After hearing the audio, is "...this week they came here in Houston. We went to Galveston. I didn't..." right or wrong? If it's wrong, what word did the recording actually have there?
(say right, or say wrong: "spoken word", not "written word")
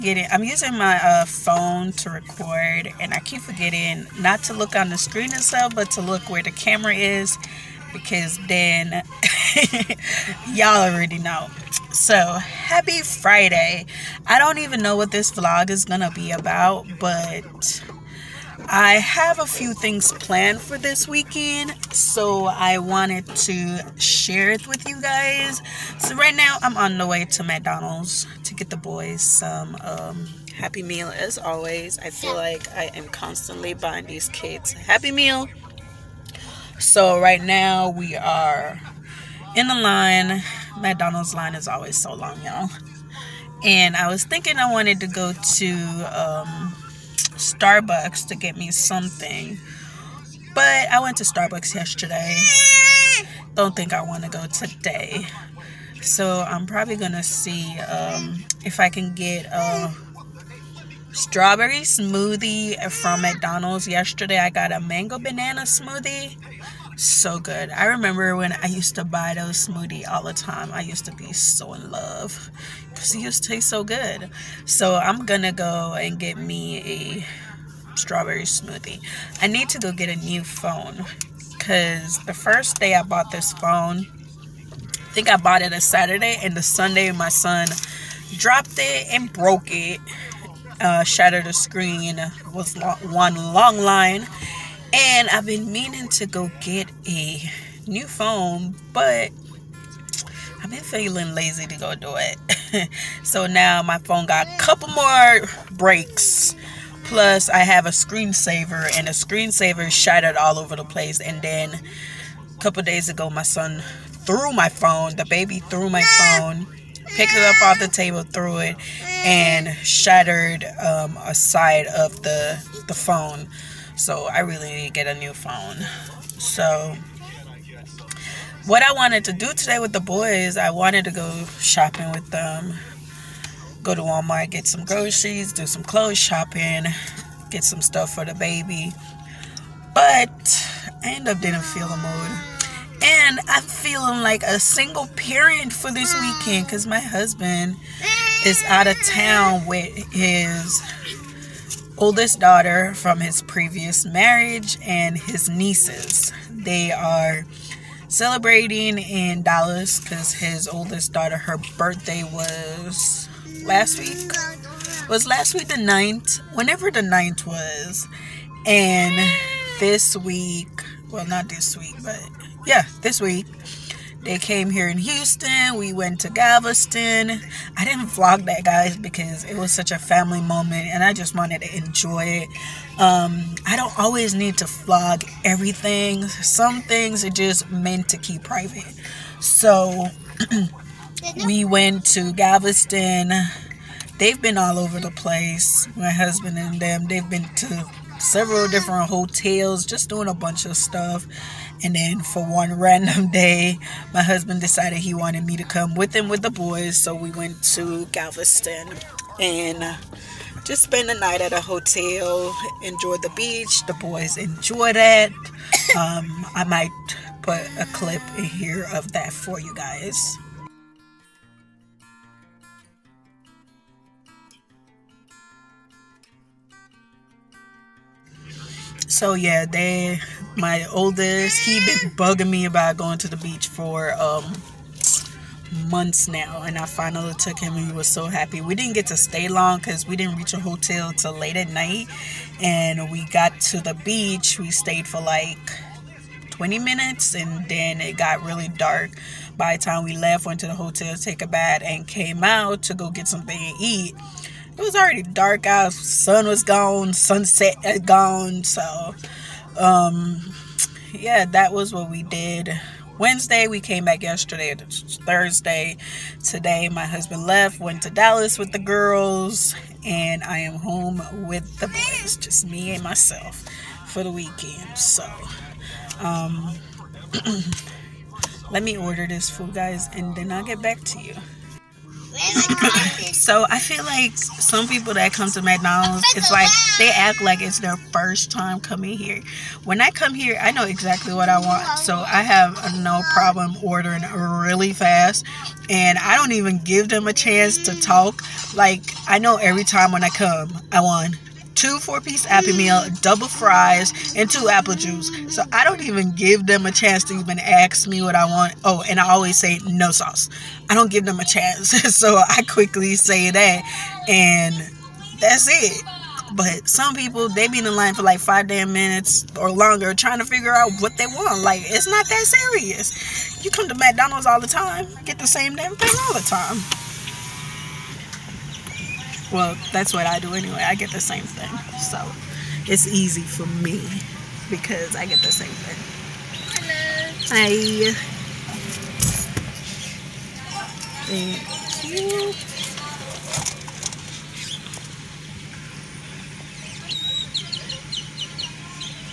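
right.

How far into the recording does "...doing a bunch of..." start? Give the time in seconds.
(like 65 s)
200 s.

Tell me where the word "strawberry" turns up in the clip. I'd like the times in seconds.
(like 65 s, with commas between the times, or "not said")
61 s, 77 s.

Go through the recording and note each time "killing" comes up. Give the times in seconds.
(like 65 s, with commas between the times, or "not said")
not said.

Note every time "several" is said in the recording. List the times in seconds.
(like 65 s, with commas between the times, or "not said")
198 s.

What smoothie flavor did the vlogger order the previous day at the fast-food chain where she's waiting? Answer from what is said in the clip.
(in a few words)
Mango banana.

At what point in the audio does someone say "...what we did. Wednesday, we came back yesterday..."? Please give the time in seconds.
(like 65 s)
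261 s.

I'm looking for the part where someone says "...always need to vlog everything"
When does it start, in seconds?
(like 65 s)
183 s.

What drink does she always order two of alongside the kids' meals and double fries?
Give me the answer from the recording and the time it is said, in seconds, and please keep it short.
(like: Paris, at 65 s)
Apple juice, at 304 s.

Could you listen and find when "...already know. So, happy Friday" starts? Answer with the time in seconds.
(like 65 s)
10 s.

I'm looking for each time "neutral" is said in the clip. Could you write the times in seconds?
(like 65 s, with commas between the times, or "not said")
not said.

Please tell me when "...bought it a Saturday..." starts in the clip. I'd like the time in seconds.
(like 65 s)
85 s.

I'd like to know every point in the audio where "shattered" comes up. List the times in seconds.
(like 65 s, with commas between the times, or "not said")
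91 s, 109 s, 119 s.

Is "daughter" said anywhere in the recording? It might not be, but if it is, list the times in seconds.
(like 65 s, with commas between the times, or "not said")
152 s, 161 s.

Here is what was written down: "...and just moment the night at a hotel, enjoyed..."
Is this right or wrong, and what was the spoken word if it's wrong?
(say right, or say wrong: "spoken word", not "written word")
wrong: "spent", not "moment".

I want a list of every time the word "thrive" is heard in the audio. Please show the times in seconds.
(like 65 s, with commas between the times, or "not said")
not said.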